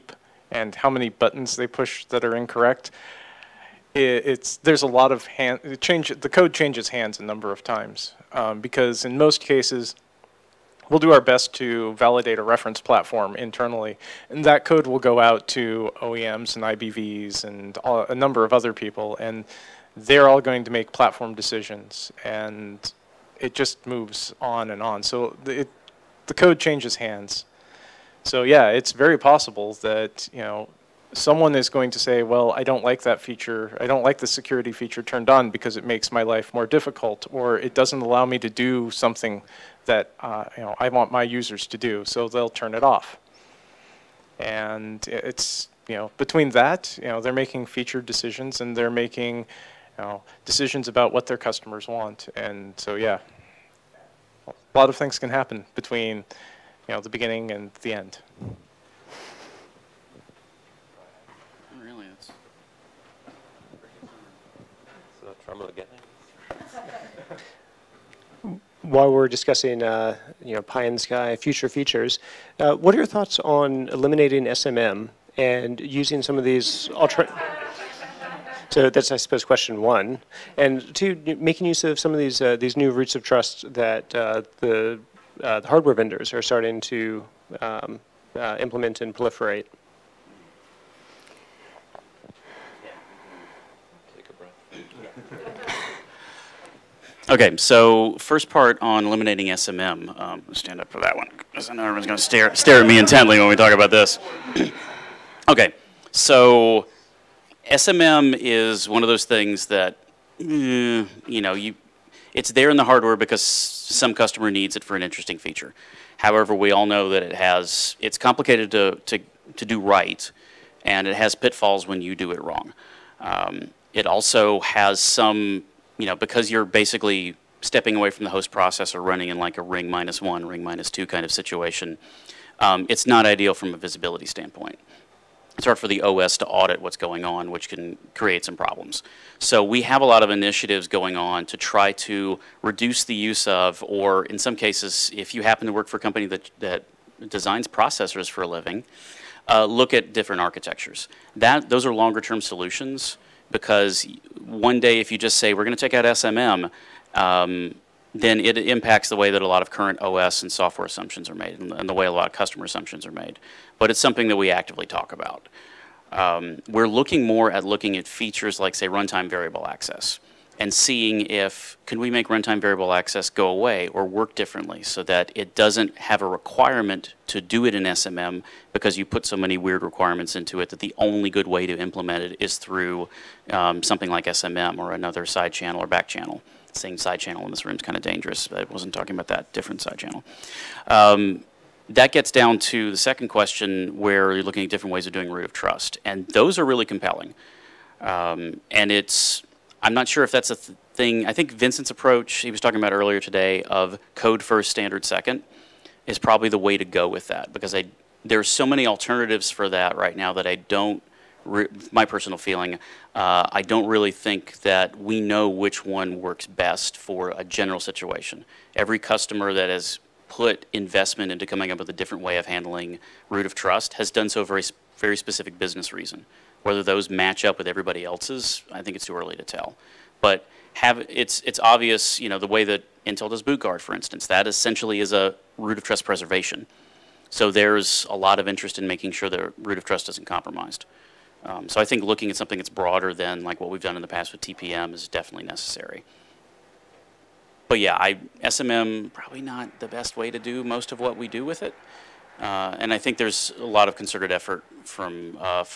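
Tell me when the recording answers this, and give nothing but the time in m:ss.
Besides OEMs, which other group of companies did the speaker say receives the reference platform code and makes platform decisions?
0:16.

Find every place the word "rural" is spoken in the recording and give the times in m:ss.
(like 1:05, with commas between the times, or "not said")
not said.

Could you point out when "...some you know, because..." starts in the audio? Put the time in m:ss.
2:04.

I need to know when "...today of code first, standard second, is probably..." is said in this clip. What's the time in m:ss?
3:23.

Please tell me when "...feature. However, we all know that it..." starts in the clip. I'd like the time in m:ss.
1:55.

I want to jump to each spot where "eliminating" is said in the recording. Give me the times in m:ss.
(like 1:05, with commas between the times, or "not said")
1:13, 1:39.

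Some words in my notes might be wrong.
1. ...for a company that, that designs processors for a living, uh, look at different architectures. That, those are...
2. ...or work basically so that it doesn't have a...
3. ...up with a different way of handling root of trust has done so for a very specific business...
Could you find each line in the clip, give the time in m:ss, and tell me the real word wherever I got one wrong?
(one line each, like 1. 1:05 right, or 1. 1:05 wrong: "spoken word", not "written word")
1. 2:25 right
2. 2:53 wrong: "differently", not "basically"
3. 3:41 right.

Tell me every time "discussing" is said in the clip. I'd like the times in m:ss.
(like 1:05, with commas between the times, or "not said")
1:09.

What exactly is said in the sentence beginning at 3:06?
Saying side channel in this room is kind of dangerous.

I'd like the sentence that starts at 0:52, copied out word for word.
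And so, yeah, a lot of things can happen between, you know, the beginning and the end.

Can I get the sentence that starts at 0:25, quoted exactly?
So the, it, the code changes hands.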